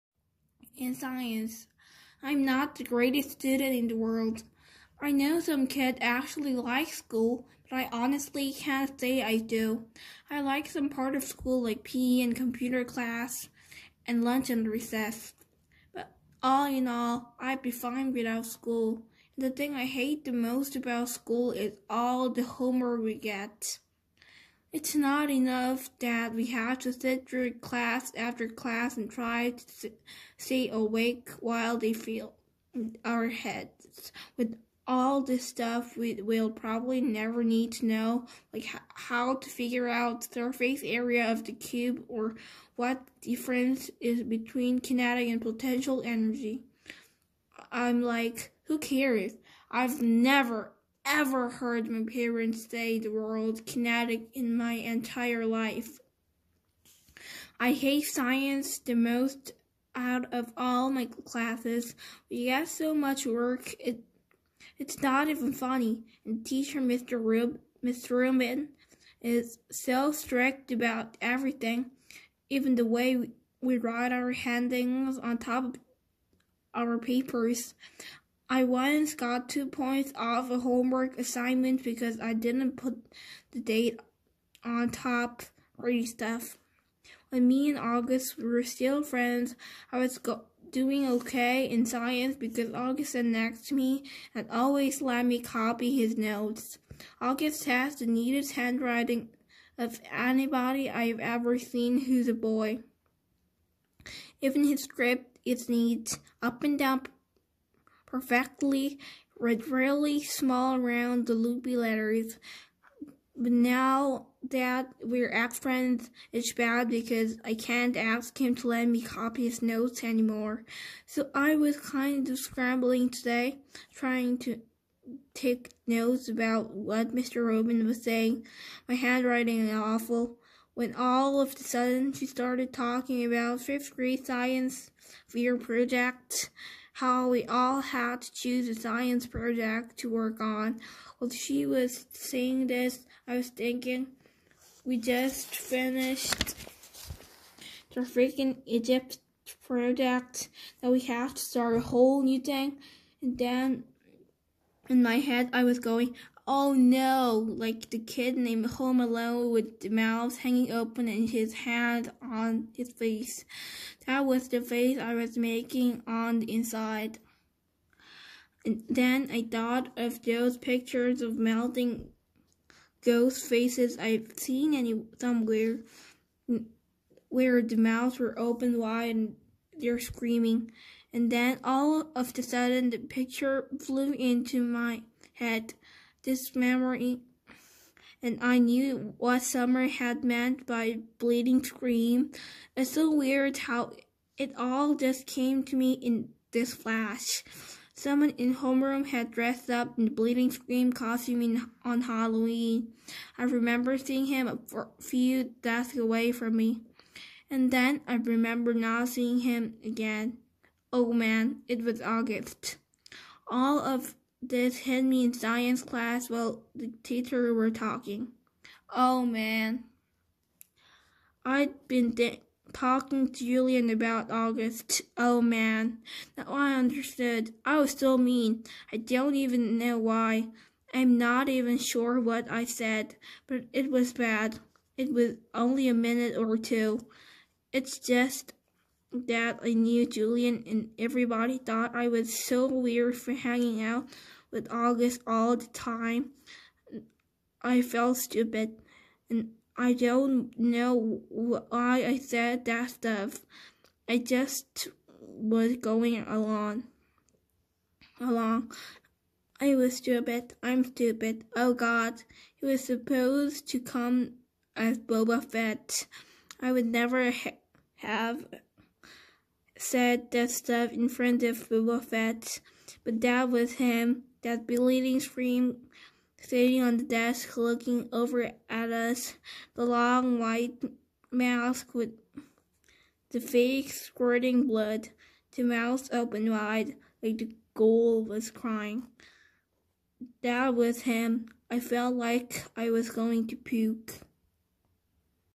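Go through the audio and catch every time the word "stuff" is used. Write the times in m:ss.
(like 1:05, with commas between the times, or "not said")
0:35, 1:26, 4:12, 4:30.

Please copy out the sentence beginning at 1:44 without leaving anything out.
Even his script is neat, up and down perfectly read really small around the loopy letters.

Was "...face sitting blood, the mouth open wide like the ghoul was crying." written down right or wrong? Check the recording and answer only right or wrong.
wrong.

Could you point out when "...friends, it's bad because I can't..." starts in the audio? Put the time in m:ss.
1:55.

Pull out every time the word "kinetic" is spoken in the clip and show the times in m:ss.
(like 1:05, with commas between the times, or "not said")
0:44, 0:53.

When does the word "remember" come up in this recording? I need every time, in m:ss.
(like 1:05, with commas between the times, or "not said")
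3:23, 3:28.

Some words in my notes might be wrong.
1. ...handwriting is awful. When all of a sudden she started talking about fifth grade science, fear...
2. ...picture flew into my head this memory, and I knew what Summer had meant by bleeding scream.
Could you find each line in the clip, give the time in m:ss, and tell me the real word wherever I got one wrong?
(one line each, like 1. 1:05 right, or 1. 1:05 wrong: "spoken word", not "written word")
1. 2:08 right
2. 3:02 right.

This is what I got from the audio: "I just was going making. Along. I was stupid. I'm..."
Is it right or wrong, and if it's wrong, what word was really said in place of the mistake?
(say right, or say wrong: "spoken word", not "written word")
wrong: "along", not "making".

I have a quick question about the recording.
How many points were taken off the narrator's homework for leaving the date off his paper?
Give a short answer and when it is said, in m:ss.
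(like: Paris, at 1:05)
2, at 1:19.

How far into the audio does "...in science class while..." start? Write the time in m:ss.
3:35.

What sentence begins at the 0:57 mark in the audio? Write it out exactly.
I hate science the most out of all my classes.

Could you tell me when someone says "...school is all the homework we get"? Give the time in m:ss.
0:21.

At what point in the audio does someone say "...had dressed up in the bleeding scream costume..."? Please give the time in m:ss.
3:19.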